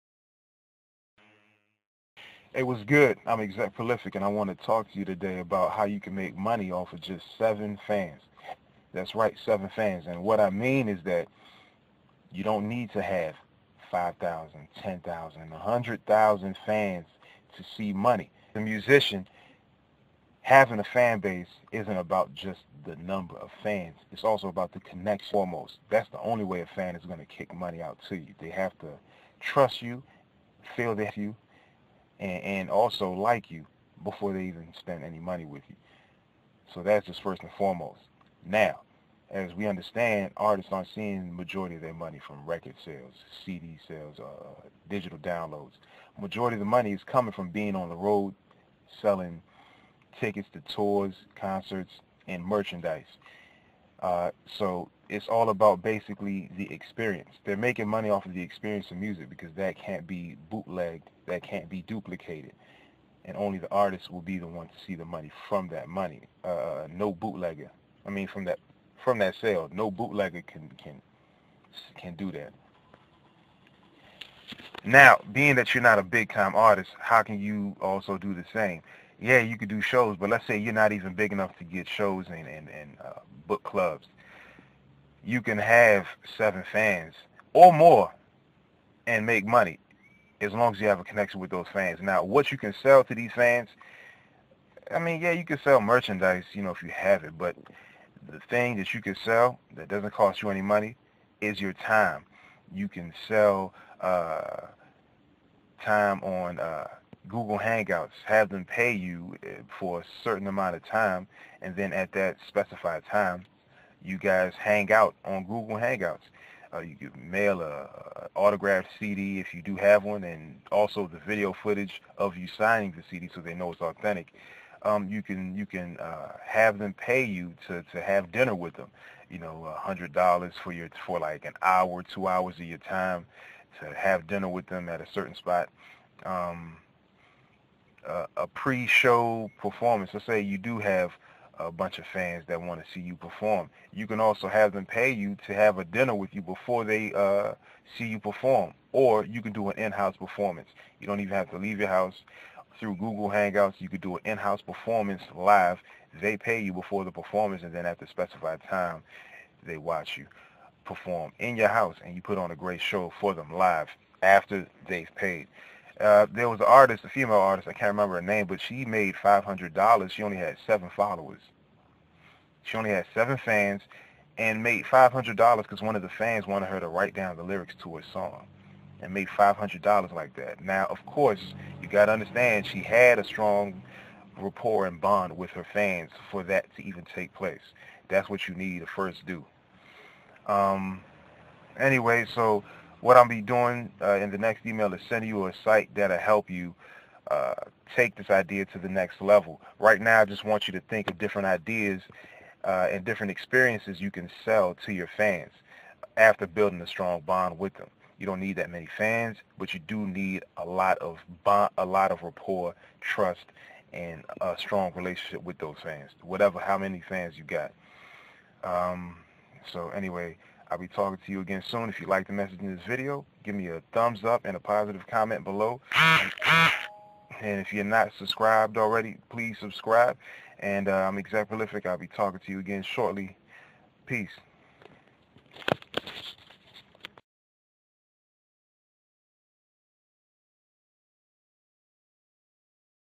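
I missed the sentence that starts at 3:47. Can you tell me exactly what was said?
And if you're not subscribed already, please subscribe.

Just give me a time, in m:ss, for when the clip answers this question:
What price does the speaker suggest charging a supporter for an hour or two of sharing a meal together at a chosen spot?
2:09.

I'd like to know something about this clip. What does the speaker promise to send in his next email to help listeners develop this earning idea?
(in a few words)
A site.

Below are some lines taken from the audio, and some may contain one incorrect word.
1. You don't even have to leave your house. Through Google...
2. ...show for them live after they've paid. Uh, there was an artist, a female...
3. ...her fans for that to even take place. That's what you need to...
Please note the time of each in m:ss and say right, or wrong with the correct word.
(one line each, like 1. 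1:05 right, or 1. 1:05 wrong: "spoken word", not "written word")
1. 2:30 right
2. 2:42 right
3. 3:05 right.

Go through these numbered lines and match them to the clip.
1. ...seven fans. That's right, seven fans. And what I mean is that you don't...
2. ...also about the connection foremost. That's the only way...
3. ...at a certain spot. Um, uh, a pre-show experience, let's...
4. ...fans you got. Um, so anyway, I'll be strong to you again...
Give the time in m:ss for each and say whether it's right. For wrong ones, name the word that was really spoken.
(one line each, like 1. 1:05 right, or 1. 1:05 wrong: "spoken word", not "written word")
1. 0:07 right
2. 0:24 right
3. 2:14 wrong: "performance", not "experience"
4. 3:37 wrong: "talking", not "strong".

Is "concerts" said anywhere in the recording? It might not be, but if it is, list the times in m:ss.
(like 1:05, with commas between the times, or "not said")
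0:51.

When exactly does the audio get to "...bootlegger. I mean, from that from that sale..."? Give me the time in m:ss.
1:07.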